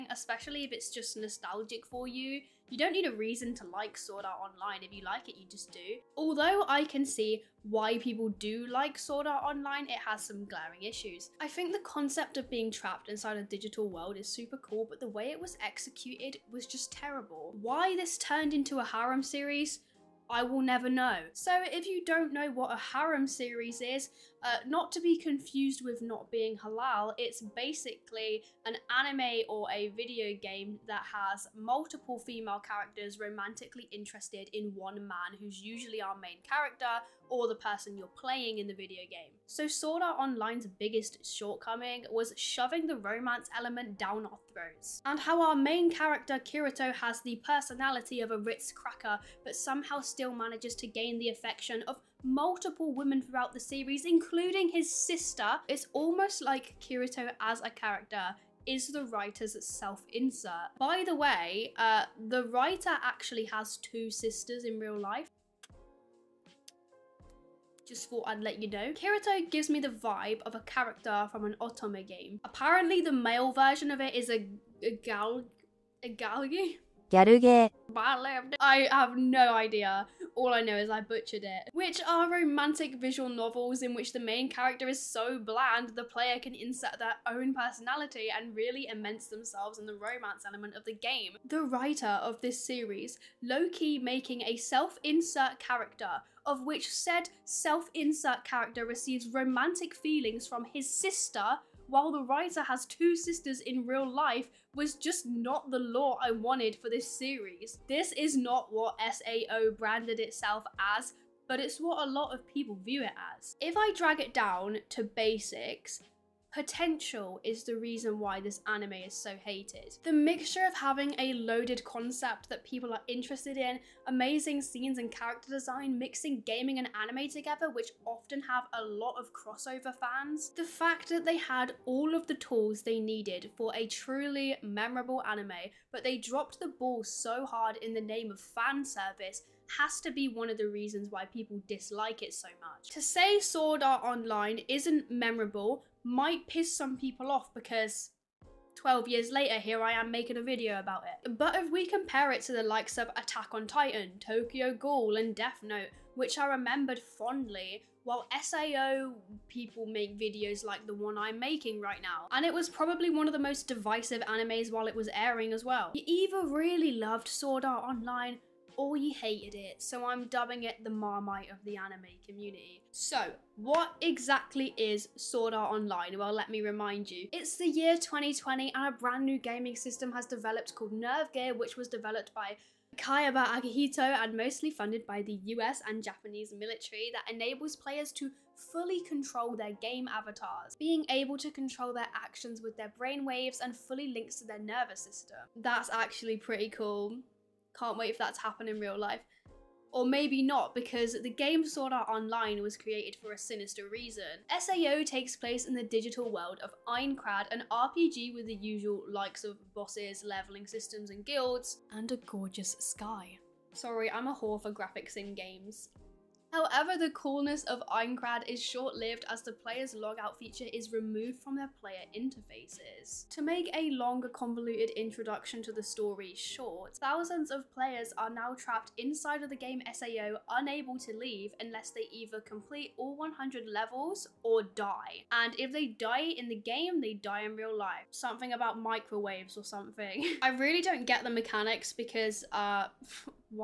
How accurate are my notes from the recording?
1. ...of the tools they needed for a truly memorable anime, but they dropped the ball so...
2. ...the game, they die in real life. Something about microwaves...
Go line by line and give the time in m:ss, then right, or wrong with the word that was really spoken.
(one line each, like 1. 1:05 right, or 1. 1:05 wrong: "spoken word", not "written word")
1. 2:12 right
2. 3:56 right.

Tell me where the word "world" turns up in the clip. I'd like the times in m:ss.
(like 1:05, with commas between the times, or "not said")
0:13, 3:26.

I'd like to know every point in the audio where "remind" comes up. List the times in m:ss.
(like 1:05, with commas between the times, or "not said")
2:56.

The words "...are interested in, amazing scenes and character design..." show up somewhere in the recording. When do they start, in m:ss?
2:02.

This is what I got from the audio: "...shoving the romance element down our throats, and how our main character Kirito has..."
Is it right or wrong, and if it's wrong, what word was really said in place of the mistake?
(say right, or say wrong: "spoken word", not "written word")
right.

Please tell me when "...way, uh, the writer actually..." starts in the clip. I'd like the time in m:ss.
1:01.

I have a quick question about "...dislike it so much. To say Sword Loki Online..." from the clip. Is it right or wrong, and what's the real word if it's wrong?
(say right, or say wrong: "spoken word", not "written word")
wrong: "Art", not "Loki".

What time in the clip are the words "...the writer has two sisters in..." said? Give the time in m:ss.
1:42.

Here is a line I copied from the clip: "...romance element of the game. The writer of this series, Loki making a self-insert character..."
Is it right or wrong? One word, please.
right.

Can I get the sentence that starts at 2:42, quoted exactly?
And it was probably one of the most divisive animes while it was airing as well.